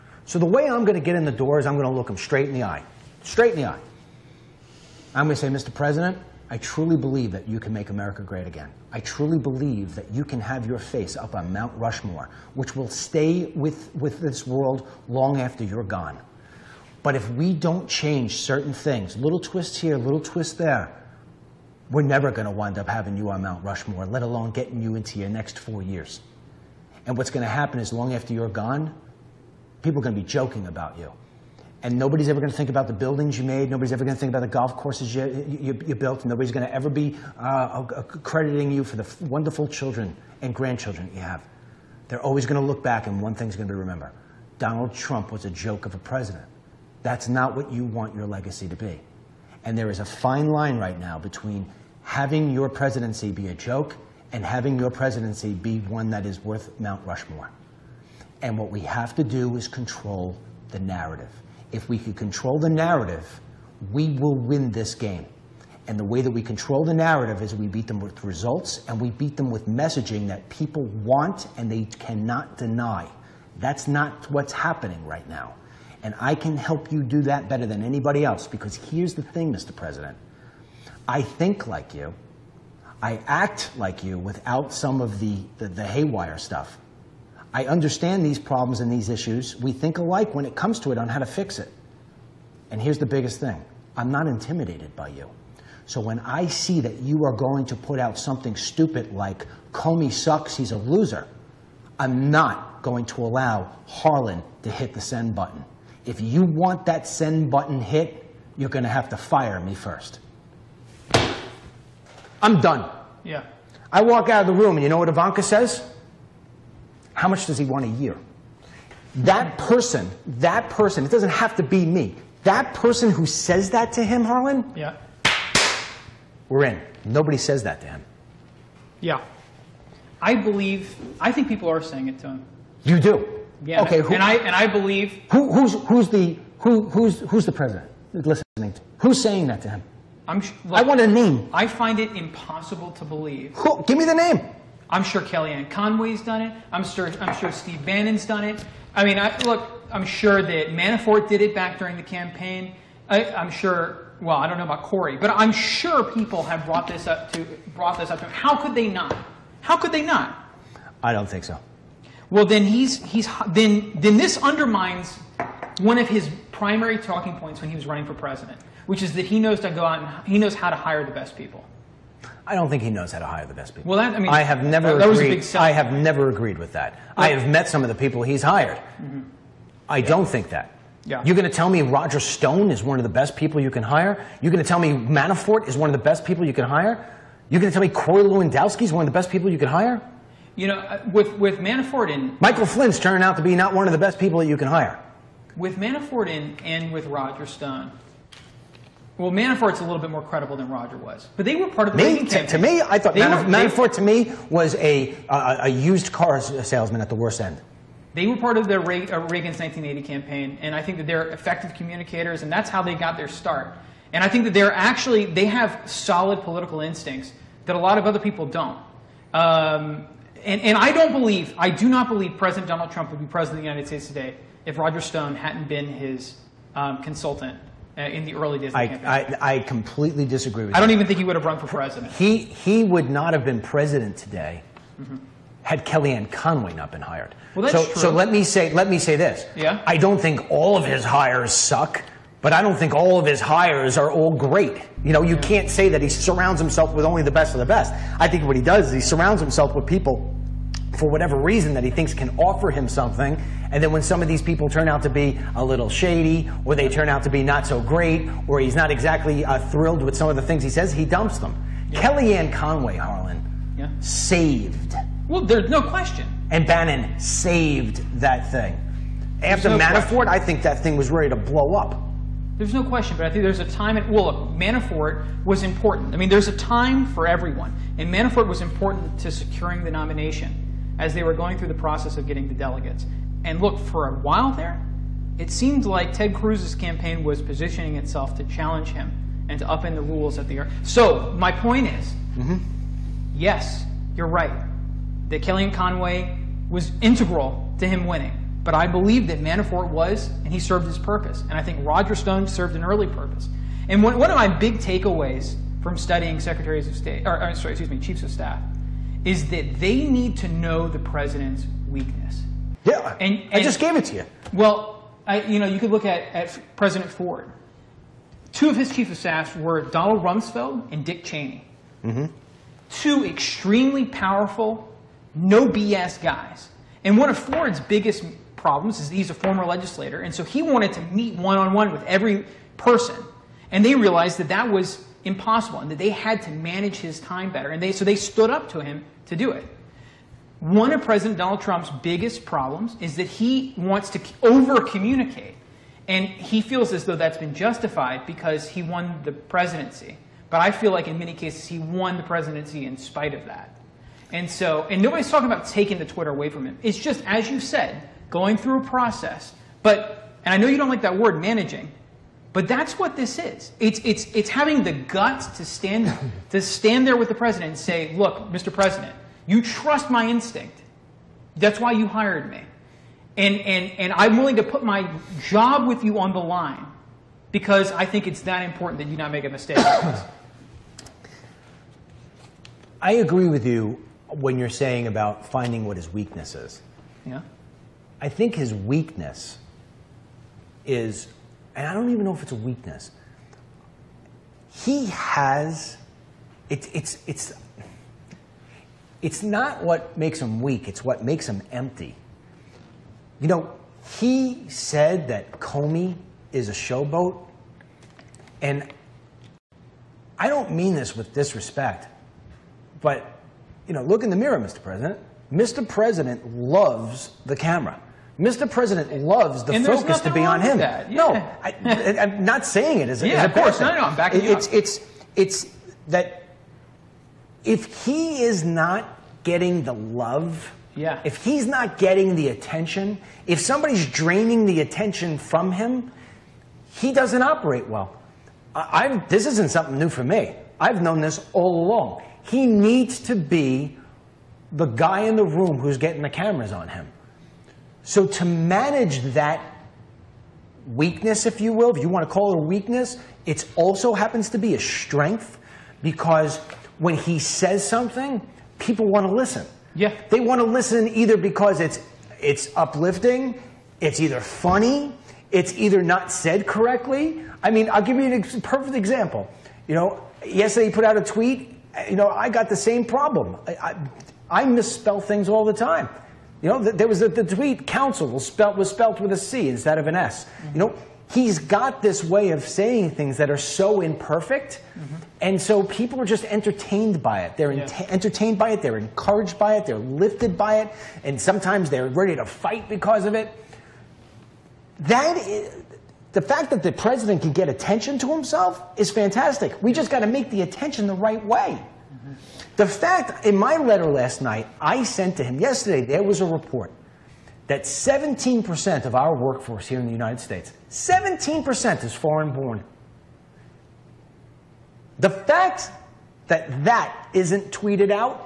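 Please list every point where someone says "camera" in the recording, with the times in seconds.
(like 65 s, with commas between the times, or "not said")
417 s, 446 s.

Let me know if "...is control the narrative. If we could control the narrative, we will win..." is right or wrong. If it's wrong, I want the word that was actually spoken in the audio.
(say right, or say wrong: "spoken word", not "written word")
right.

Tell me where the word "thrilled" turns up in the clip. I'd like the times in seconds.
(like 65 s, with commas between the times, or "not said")
259 s.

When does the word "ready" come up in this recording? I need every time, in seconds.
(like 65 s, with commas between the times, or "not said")
271 s, 492 s.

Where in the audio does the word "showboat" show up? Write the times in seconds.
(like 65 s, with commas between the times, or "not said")
406 s.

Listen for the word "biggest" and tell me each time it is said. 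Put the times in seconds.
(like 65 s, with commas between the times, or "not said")
93 s, 327 s, 342 s.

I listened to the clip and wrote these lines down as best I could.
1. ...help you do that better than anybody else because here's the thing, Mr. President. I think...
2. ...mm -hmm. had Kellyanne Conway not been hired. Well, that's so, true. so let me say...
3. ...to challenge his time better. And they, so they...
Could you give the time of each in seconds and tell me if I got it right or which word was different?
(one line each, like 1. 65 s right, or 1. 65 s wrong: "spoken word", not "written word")
1. 76 s right
2. 235 s right
3. 336 s wrong: "manage", not "challenge".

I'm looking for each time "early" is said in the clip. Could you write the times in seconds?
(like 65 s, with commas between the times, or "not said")
228 s, 302 s.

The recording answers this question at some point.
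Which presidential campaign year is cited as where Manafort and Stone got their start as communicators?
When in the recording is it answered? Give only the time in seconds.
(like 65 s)
209 s.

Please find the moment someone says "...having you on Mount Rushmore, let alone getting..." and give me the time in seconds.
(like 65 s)
22 s.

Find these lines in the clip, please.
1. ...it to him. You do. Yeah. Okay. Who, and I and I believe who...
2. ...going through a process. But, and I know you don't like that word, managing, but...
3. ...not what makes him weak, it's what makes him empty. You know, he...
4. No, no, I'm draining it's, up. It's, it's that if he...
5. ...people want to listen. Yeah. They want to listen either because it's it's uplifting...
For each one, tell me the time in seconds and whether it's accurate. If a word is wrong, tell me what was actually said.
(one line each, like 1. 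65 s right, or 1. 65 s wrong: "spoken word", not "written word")
1. 132 s right
2. 358 s right
3. 399 s right
4. 423 s wrong: "backing", not "draining"
5. 458 s right.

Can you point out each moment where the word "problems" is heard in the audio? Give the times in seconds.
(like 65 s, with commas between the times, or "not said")
88 s, 328 s, 342 s, 473 s.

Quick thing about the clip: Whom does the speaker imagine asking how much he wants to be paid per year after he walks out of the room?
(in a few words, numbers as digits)
Ivanka.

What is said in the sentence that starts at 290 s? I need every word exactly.
So my point is, mm -hmm.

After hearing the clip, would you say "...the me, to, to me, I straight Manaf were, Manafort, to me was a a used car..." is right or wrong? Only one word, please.
wrong.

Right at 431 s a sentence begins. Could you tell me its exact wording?
if he's not getting the attention, if somebody's draining the attention from him, he doesn't operate well.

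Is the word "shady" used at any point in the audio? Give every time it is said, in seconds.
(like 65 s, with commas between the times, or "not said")
255 s.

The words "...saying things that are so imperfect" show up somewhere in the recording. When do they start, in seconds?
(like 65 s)
482 s.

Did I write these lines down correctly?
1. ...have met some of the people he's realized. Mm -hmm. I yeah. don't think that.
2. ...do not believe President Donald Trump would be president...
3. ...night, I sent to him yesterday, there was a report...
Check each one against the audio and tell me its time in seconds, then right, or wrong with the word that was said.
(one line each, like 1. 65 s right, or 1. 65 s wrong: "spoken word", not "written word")
1. 177 s wrong: "hired", not "realized"
2. 221 s right
3. 504 s right.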